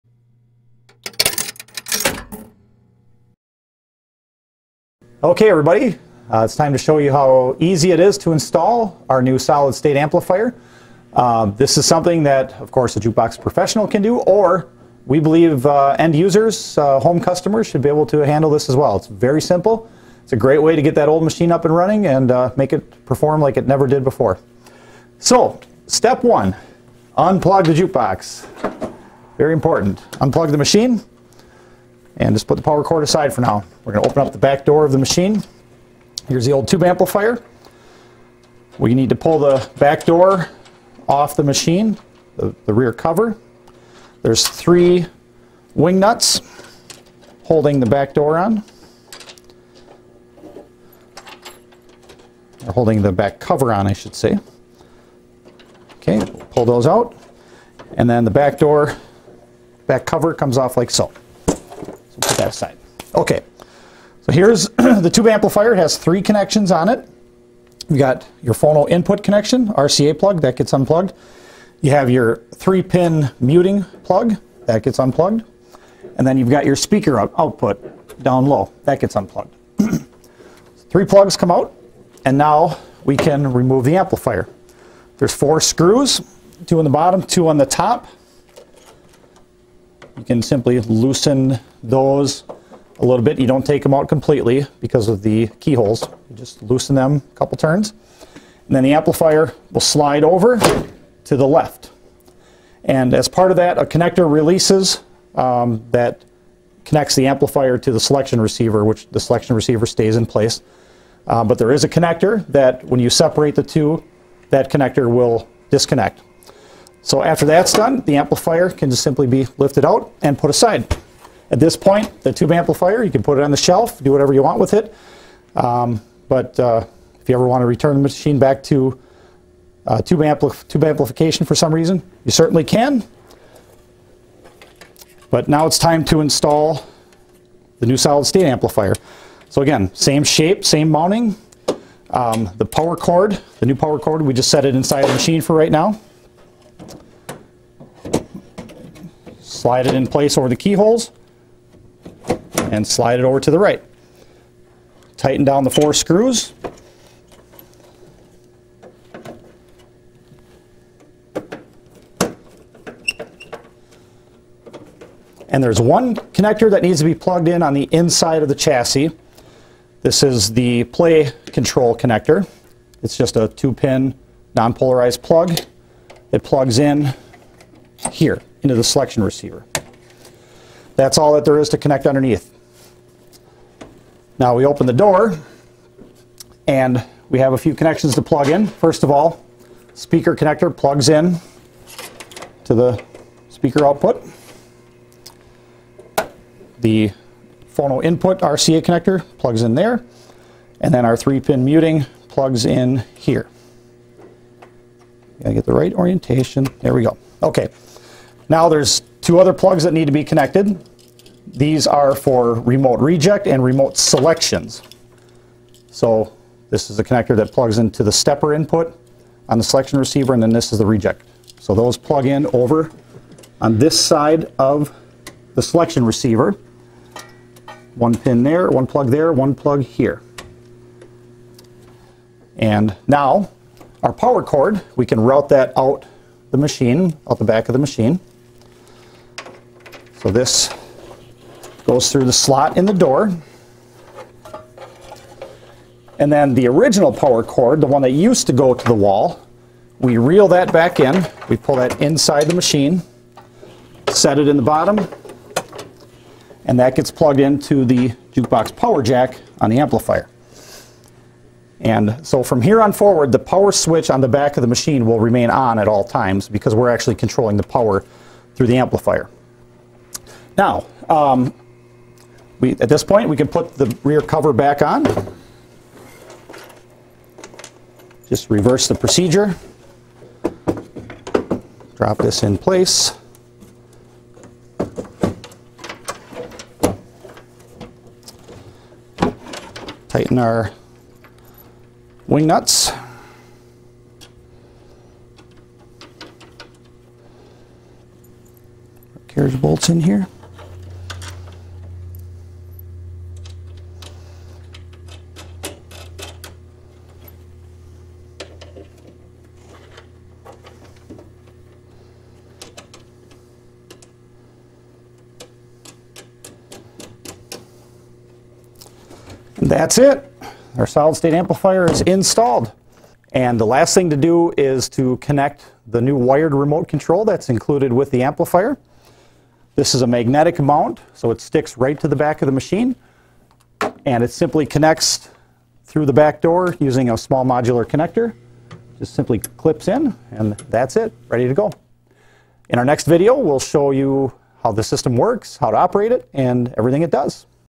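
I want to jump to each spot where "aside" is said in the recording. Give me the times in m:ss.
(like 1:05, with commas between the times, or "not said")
0:33, 1:02, 2:00.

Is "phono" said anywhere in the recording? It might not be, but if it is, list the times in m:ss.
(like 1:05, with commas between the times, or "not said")
1:08, 3:17.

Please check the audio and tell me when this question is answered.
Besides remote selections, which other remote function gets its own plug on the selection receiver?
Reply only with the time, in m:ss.
3:32.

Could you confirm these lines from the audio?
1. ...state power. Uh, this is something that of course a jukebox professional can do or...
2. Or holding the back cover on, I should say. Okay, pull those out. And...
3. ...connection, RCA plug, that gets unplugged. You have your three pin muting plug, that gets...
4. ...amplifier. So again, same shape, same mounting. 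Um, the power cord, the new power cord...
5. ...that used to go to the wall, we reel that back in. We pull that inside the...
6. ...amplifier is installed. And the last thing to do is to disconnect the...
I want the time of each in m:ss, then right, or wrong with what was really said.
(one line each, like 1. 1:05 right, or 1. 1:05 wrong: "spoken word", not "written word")
1. 0:09 wrong: "amplifier", not "power"
2. 0:52 right
3. 1:09 right
4. 2:18 right
5. 4:08 right
6. 5:21 wrong: "connect", not "disconnect".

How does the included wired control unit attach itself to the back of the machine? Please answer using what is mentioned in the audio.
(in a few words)
Magnetic mount.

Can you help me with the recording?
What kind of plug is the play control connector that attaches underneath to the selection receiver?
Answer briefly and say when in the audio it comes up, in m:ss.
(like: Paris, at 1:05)
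two-pin non-polarized plug, at 2:53.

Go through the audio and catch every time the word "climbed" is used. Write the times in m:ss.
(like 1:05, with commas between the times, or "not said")
not said.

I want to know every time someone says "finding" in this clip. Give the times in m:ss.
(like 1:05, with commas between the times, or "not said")
not said.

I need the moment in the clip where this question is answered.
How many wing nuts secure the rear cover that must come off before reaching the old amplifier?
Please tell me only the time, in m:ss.
0:44.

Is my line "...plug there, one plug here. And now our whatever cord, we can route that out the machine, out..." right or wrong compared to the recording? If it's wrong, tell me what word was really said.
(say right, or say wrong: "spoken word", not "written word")
wrong: "power", not "whatever".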